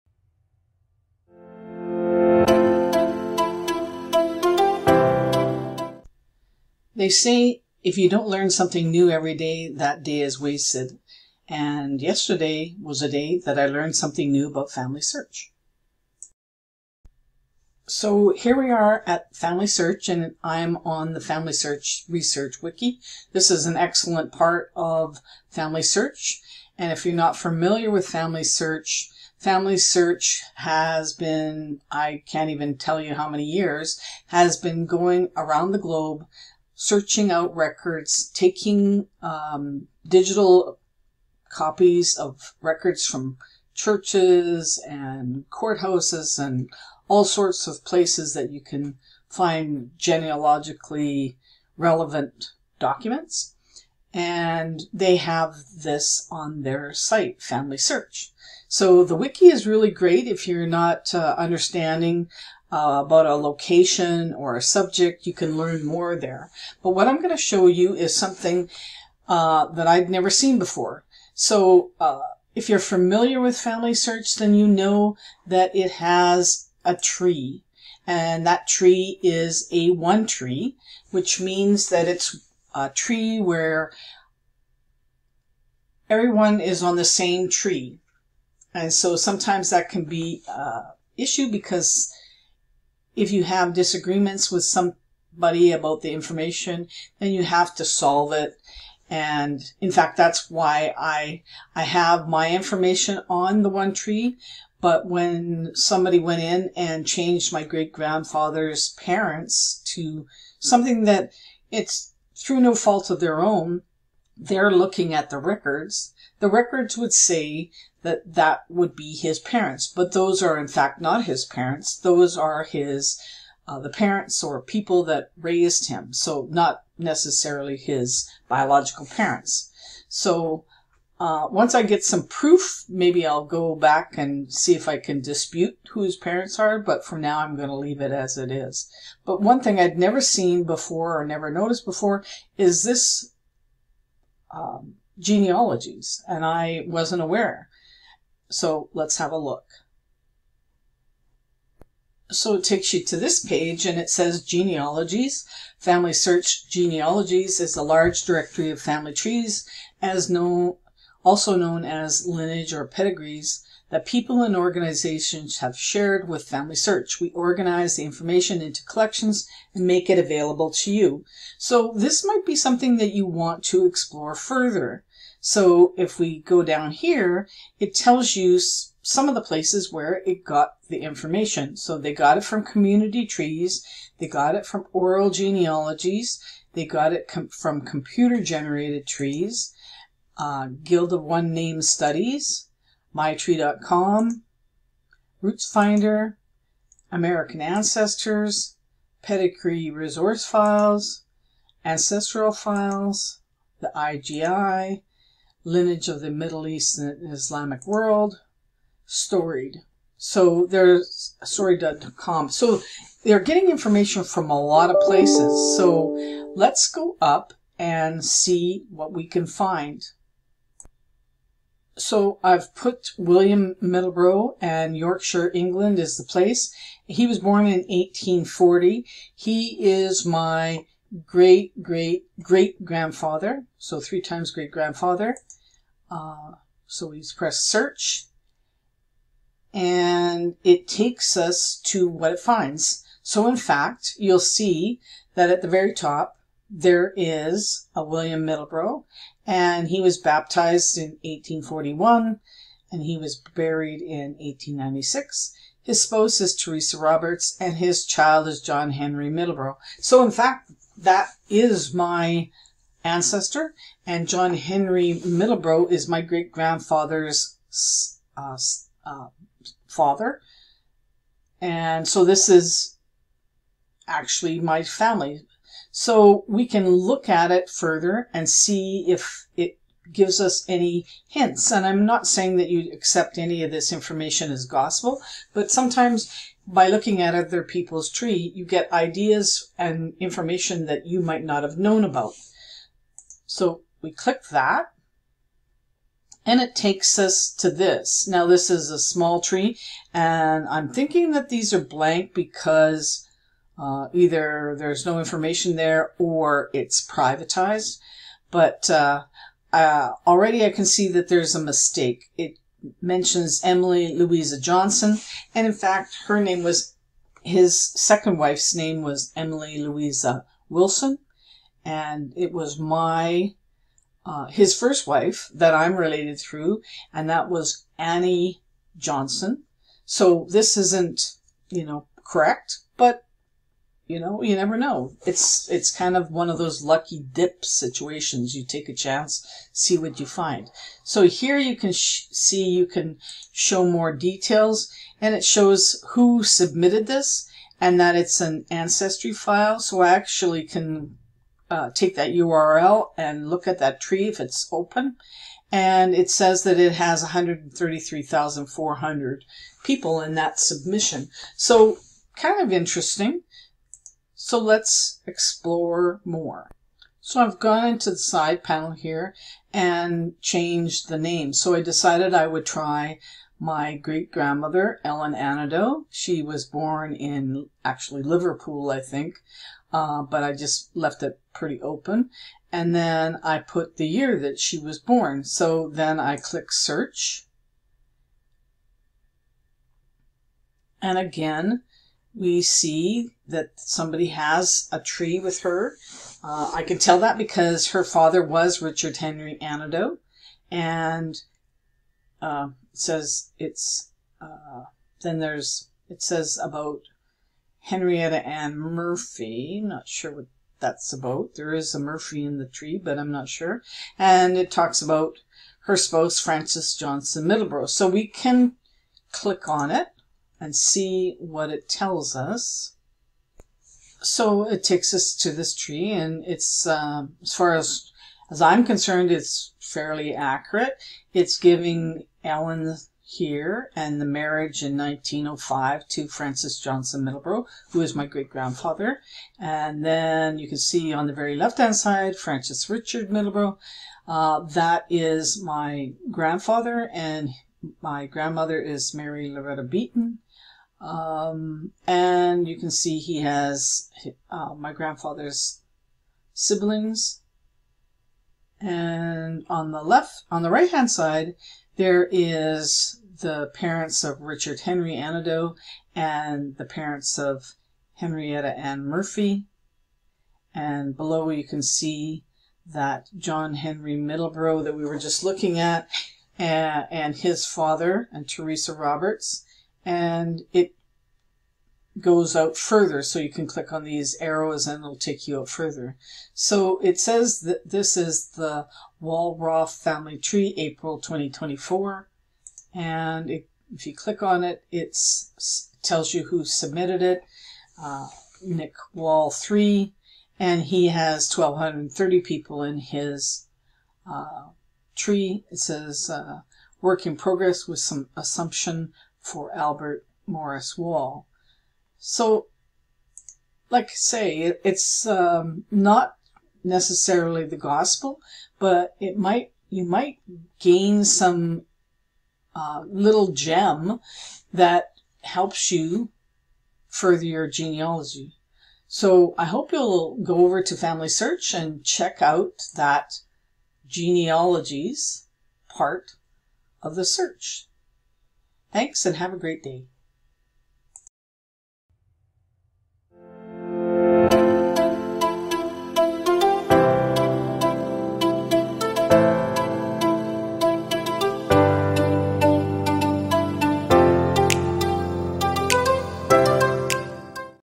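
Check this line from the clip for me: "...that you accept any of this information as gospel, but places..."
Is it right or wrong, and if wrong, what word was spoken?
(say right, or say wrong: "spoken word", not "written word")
wrong: "sometimes", not "places".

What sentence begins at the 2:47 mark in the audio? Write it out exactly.
We organize the information into collections and make it available to you.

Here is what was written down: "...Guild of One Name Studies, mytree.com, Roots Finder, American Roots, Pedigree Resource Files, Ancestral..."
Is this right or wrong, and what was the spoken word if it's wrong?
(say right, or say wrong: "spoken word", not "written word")
wrong: "Ancestors", not "Roots".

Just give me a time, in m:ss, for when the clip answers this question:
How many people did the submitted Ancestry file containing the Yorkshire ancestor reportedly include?
5:57.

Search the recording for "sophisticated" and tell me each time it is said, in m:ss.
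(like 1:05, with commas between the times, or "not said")
not said.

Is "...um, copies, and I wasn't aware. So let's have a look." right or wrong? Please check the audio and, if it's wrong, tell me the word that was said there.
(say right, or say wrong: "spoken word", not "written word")
wrong: "genealogies", not "copies".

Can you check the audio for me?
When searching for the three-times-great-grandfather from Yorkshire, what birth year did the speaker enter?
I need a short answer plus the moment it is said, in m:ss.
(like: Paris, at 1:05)
1840, at 3:47.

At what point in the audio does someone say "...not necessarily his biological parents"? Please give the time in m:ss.
2:06.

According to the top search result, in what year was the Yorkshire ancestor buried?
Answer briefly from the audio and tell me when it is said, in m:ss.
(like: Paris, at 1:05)
1896, at 4:14.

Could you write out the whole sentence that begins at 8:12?
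And it, if you click on it, it tells you who submitted it.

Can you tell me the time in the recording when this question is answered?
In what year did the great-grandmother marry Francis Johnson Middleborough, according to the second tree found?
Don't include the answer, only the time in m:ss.
7:14.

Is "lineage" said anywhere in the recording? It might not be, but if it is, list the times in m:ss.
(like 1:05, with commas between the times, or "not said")
2:42, 3:25.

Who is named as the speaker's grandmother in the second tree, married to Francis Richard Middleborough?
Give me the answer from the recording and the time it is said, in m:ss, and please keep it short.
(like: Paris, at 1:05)
Mary Loretta Beaton, at 7:29.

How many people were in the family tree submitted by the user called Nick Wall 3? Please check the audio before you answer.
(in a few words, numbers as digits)
1,230.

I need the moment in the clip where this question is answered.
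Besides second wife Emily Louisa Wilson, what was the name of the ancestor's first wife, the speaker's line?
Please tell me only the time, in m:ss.
5:27.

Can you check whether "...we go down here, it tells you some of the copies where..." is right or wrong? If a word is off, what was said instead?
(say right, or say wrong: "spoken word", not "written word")
wrong: "places", not "copies".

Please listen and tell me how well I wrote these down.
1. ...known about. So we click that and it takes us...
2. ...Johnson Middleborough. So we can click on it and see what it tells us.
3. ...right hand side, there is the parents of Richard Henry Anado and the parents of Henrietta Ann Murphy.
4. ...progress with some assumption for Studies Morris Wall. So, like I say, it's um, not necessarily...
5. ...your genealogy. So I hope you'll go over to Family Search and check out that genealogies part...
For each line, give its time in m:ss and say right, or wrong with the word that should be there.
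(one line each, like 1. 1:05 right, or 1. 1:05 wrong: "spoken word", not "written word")
1. 4:51 right
2. 6:56 right
3. 7:40 right
4. 8:27 wrong: "Albert", not "Studies"
5. 8:47 right.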